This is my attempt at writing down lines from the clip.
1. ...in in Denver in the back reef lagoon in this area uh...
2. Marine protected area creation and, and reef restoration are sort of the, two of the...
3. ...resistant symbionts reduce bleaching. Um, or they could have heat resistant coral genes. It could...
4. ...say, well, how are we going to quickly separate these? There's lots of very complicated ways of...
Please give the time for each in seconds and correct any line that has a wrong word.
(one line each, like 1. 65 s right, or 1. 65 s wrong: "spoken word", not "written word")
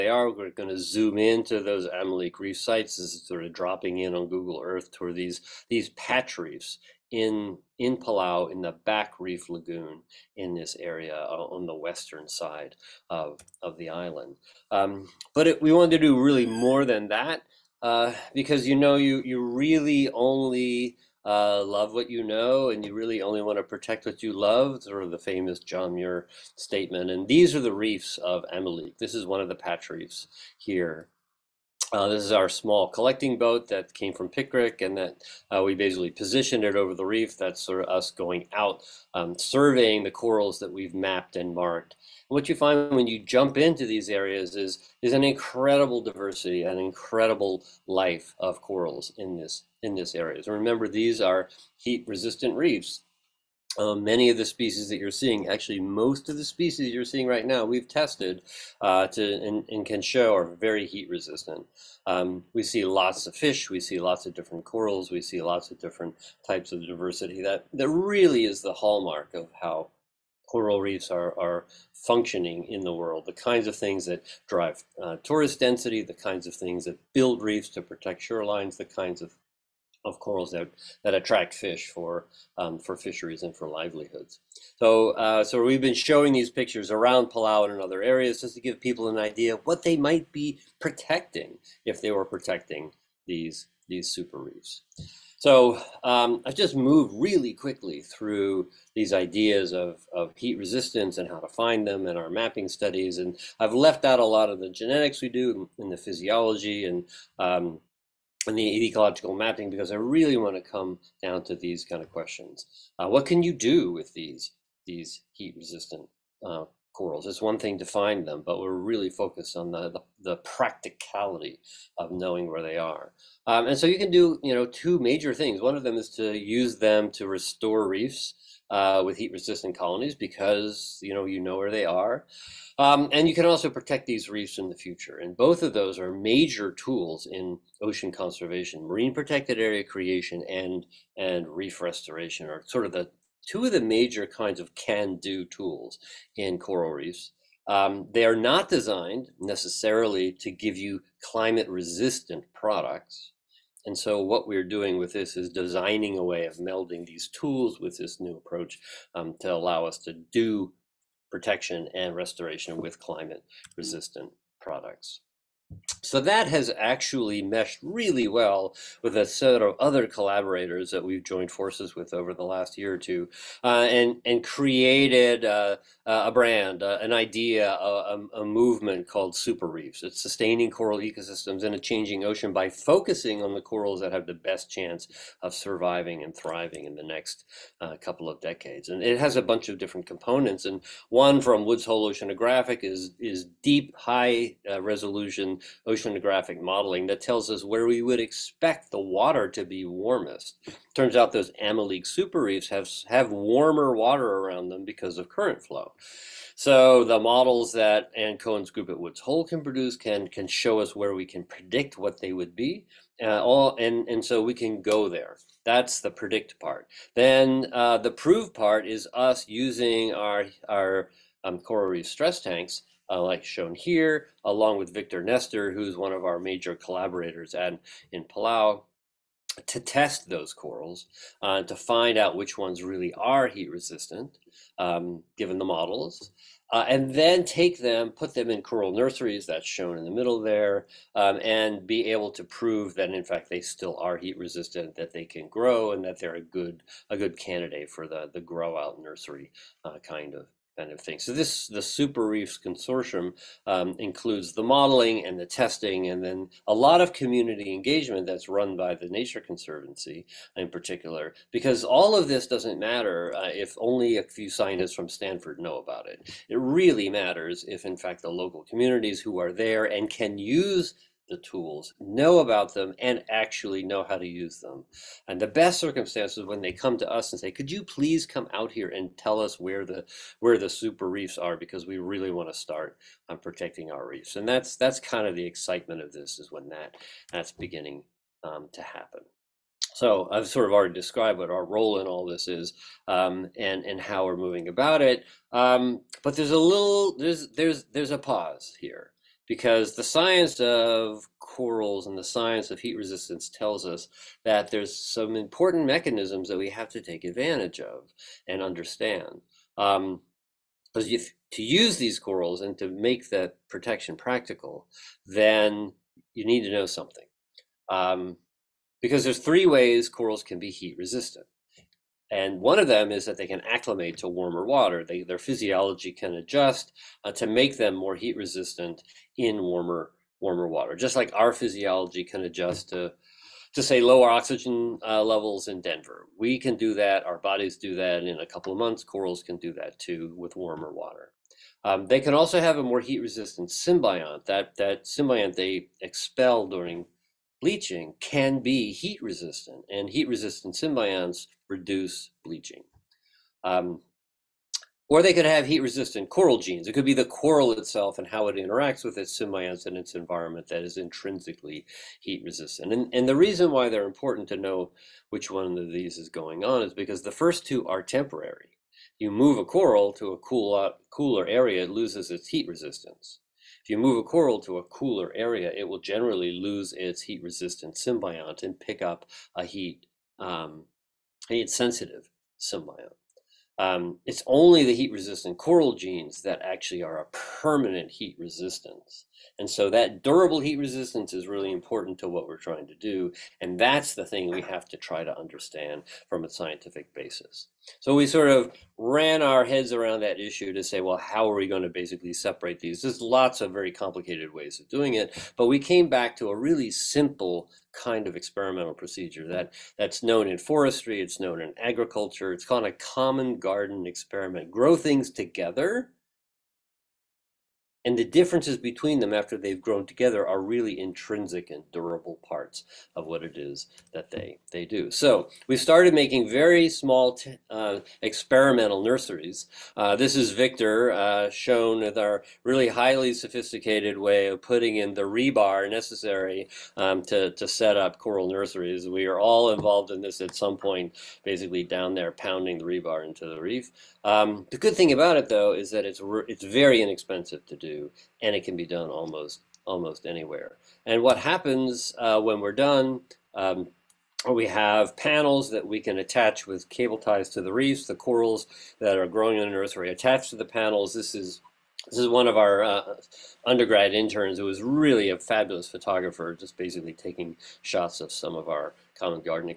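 1. 7 s wrong: "Palau", not "Denver"
2. 138 s right
3. 350 s right
4. 400 s wrong: "basically", not "quickly".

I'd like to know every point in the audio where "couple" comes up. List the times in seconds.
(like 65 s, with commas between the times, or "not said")
187 s, 338 s.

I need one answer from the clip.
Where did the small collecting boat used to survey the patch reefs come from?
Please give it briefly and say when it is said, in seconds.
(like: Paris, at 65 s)
Pickrick, at 34 s.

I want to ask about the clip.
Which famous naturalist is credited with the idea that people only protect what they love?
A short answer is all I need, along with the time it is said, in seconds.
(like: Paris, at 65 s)
John Muir, at 25 s.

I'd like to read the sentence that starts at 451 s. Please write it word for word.
And what happens uh, when we're done, um, we have panels that we can attach with cable ties to the reefs.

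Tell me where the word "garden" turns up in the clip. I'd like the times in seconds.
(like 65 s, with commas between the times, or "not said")
413 s.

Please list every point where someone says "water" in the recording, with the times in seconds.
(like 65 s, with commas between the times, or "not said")
198 s, 203 s, 324 s, 330 s, 340 s.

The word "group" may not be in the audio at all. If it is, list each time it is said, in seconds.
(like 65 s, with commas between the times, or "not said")
208 s.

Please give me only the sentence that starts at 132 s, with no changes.
Um, and you can also protect these reefs in the future.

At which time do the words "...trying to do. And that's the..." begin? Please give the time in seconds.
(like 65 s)
392 s.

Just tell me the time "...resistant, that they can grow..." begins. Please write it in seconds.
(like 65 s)
244 s.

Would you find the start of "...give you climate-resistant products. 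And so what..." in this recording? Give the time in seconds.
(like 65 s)
150 s.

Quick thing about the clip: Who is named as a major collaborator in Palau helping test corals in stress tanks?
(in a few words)
Victor Nestor.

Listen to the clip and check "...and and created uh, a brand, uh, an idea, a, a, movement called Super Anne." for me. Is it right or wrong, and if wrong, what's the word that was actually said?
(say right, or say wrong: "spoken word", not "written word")
wrong: "Reefs", not "Anne".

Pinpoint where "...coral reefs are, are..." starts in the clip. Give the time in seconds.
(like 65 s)
70 s.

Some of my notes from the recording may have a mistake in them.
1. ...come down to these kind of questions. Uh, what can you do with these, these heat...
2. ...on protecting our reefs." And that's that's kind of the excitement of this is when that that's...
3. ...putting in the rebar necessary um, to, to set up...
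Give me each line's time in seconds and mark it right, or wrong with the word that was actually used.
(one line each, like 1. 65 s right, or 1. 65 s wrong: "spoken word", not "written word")
1. 110 s right
2. 283 s right
3. 434 s right.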